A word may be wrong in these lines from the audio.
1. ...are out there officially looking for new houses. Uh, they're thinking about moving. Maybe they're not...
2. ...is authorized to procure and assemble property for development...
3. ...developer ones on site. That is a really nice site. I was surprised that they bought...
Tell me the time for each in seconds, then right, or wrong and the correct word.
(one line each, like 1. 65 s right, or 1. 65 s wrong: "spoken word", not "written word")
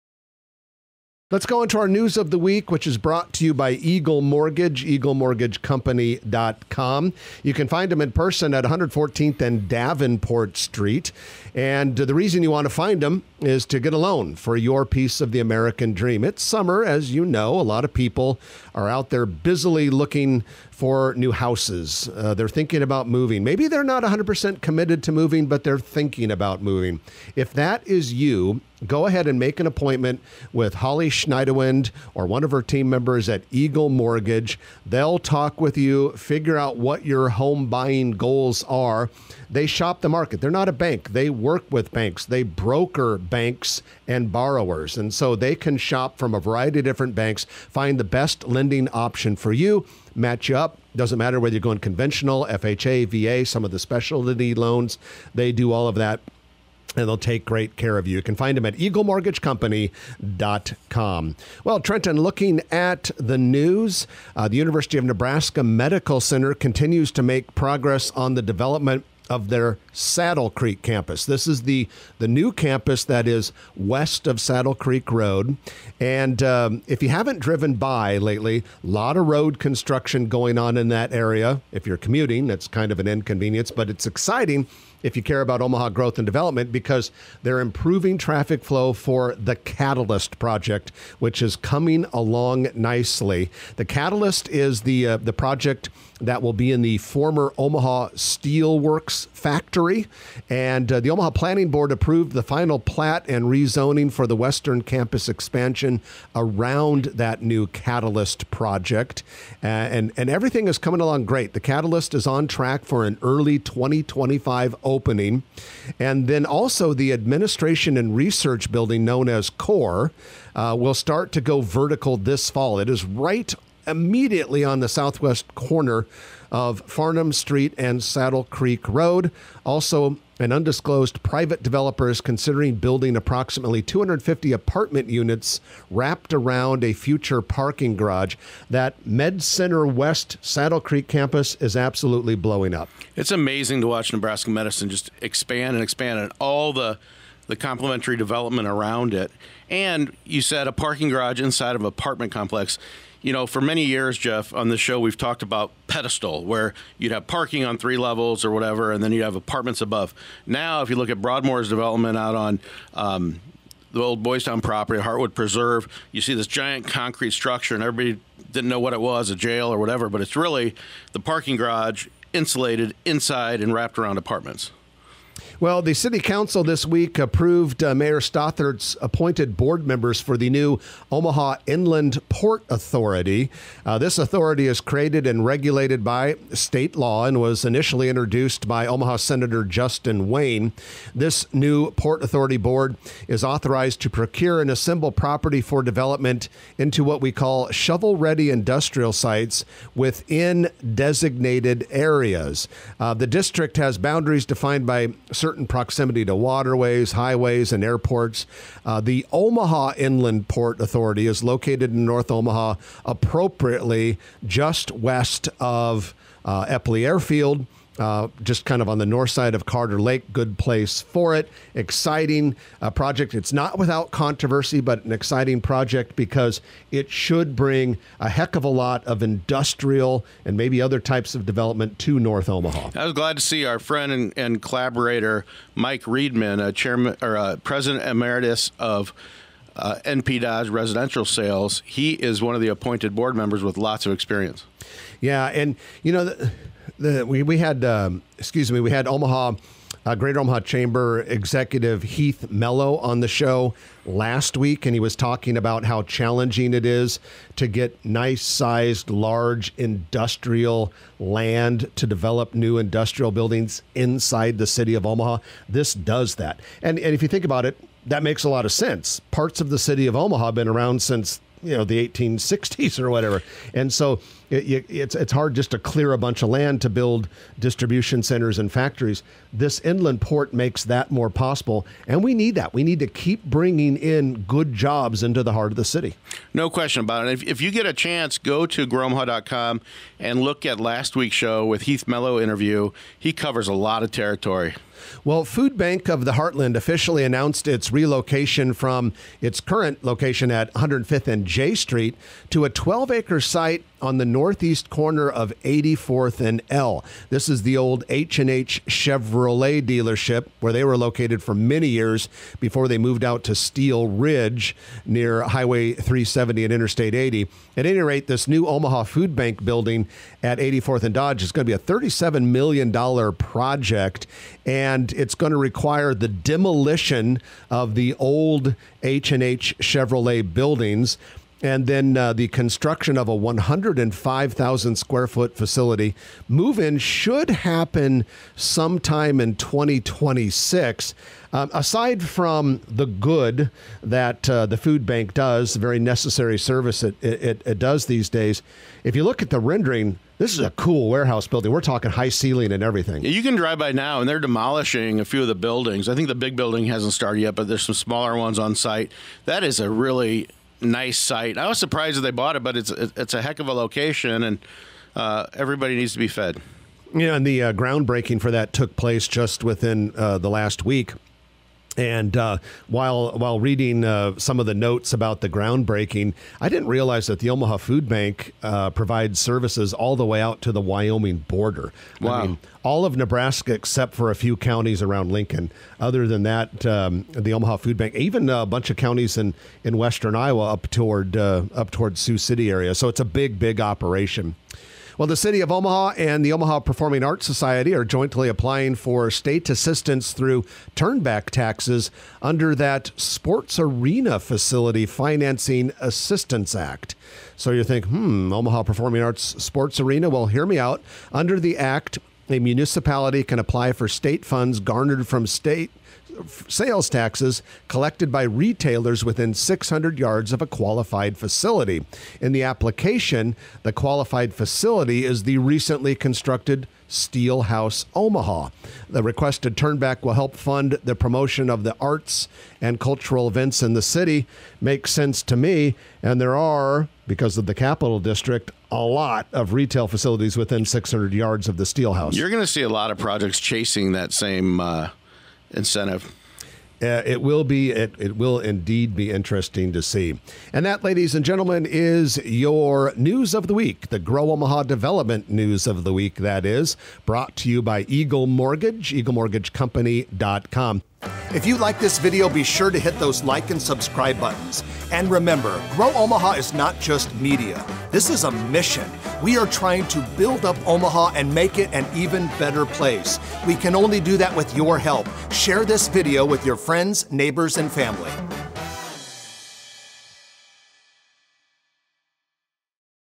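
1. 18 s wrong: "busily", not "officially"
2. 193 s right
3. 357 s wrong: "smaller", not "developer".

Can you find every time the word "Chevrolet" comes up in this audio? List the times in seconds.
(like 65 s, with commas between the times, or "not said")
308 s, 329 s.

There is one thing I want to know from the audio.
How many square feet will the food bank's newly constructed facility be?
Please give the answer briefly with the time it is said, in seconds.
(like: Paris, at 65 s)
105,000, at 333 s.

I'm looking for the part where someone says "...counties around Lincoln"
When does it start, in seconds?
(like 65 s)
384 s.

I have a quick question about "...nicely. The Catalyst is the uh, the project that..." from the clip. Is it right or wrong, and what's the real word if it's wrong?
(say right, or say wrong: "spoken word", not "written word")
right.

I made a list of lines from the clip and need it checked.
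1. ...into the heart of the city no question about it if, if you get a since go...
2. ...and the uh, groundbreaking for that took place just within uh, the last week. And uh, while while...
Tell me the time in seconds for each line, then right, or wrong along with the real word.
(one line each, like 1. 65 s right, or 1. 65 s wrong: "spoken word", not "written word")
1. 285 s wrong: "chance", not "since"
2. 367 s right.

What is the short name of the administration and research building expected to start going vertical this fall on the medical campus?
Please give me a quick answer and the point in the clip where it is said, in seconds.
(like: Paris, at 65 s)
CORE, at 119 s.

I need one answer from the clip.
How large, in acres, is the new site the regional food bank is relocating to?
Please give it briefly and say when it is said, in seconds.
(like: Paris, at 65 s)
12 acres, at 302 s.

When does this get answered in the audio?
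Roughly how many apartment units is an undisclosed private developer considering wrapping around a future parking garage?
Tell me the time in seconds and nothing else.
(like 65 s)
133 s.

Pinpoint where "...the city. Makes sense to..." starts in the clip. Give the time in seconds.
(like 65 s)
433 s.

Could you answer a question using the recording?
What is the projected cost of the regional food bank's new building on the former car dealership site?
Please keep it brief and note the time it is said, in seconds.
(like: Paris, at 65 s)
$37 million, at 321 s.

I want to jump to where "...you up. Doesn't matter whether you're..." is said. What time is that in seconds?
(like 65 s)
50 s.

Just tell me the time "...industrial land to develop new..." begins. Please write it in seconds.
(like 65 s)
259 s.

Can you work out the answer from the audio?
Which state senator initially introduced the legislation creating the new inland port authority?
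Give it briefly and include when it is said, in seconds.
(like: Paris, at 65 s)
Justin Wayne, at 189 s.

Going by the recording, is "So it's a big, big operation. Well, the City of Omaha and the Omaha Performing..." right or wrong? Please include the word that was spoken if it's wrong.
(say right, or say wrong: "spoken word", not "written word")
right.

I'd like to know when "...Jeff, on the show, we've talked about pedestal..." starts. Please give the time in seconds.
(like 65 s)
154 s.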